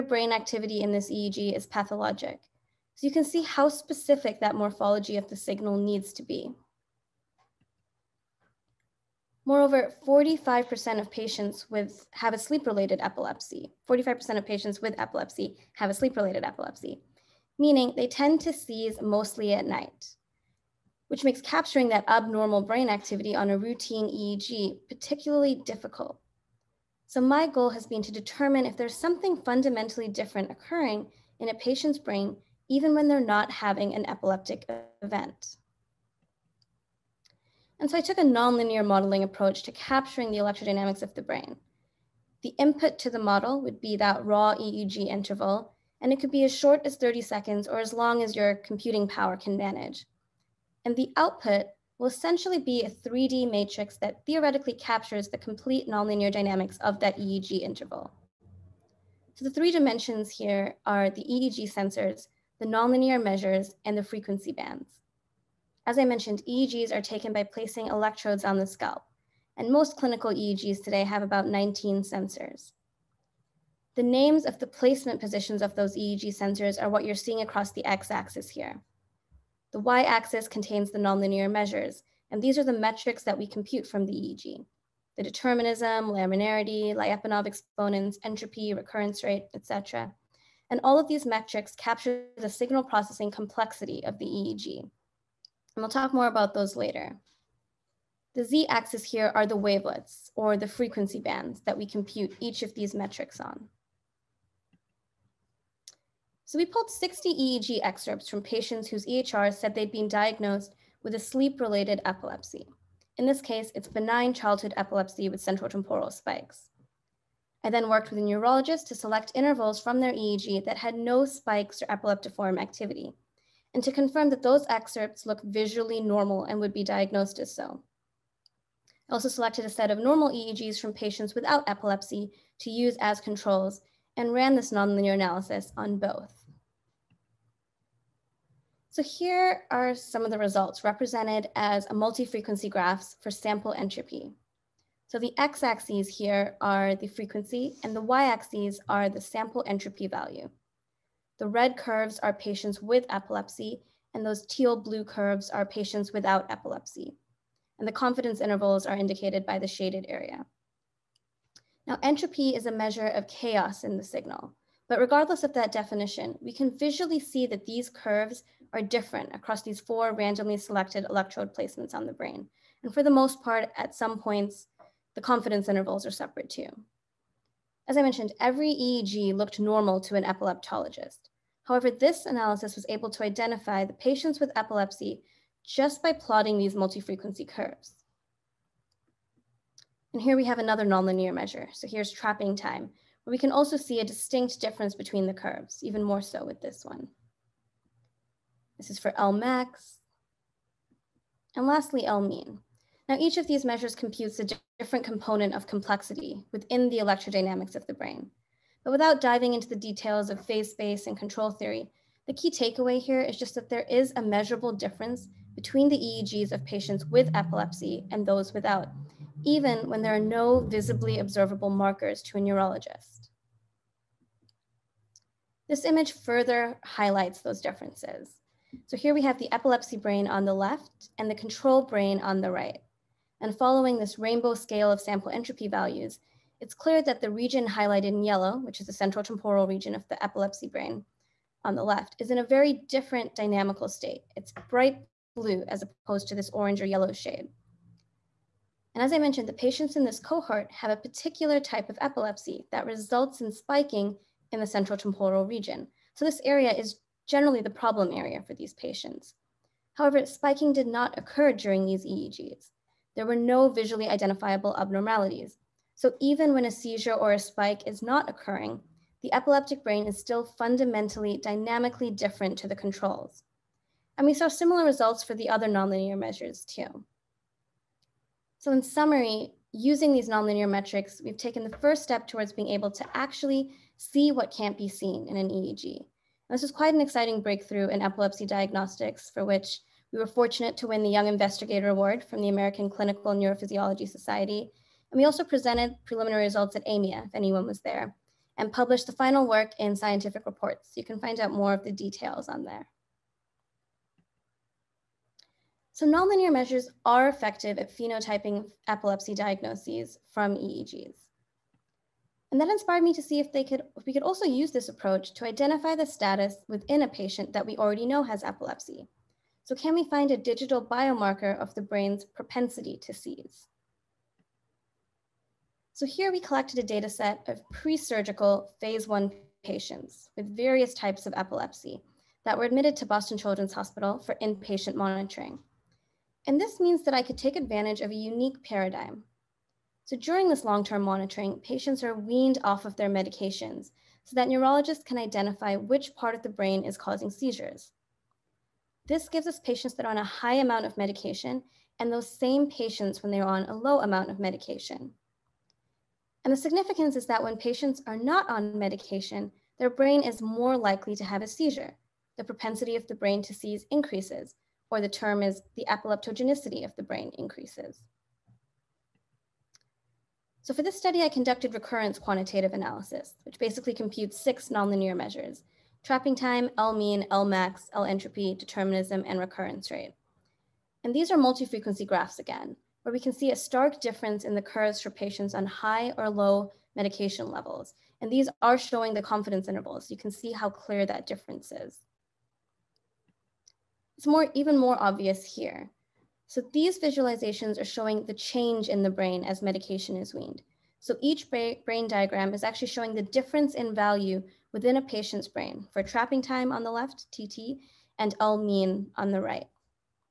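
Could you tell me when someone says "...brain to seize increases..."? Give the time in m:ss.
6:03.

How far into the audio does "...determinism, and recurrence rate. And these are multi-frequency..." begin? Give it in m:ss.
6:18.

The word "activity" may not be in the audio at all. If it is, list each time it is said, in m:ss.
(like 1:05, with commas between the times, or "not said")
0:00, 0:22, 2:02.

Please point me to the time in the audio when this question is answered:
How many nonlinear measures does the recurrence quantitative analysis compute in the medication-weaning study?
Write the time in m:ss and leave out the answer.
6:14.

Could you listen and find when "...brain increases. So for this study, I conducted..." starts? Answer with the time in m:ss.
6:07.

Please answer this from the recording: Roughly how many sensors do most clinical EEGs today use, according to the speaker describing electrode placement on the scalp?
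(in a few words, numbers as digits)
19.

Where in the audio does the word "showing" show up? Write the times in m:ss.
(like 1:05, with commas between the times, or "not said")
6:28, 6:37, 6:42.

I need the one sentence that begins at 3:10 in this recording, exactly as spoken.
And here we have another nonlinear measure.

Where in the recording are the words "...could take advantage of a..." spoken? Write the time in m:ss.
5:37.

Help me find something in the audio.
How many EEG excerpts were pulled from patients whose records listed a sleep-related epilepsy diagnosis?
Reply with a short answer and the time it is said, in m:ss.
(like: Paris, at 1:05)
60, at 1:46.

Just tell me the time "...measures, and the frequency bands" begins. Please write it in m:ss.
1:03.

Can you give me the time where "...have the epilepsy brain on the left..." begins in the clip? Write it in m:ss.
3:49.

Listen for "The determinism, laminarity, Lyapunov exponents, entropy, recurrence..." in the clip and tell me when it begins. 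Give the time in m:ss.
1:25.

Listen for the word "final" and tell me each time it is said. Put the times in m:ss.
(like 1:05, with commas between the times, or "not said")
4:59.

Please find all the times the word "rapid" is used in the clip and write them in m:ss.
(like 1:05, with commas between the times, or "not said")
not said.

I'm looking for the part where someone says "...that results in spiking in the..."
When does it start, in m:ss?
4:12.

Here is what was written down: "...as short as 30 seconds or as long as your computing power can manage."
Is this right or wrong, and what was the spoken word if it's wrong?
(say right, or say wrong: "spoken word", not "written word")
right.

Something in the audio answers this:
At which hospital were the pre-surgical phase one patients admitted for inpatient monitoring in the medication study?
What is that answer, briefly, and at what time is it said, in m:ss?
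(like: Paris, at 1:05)
Boston Children's Hospital, at 5:33.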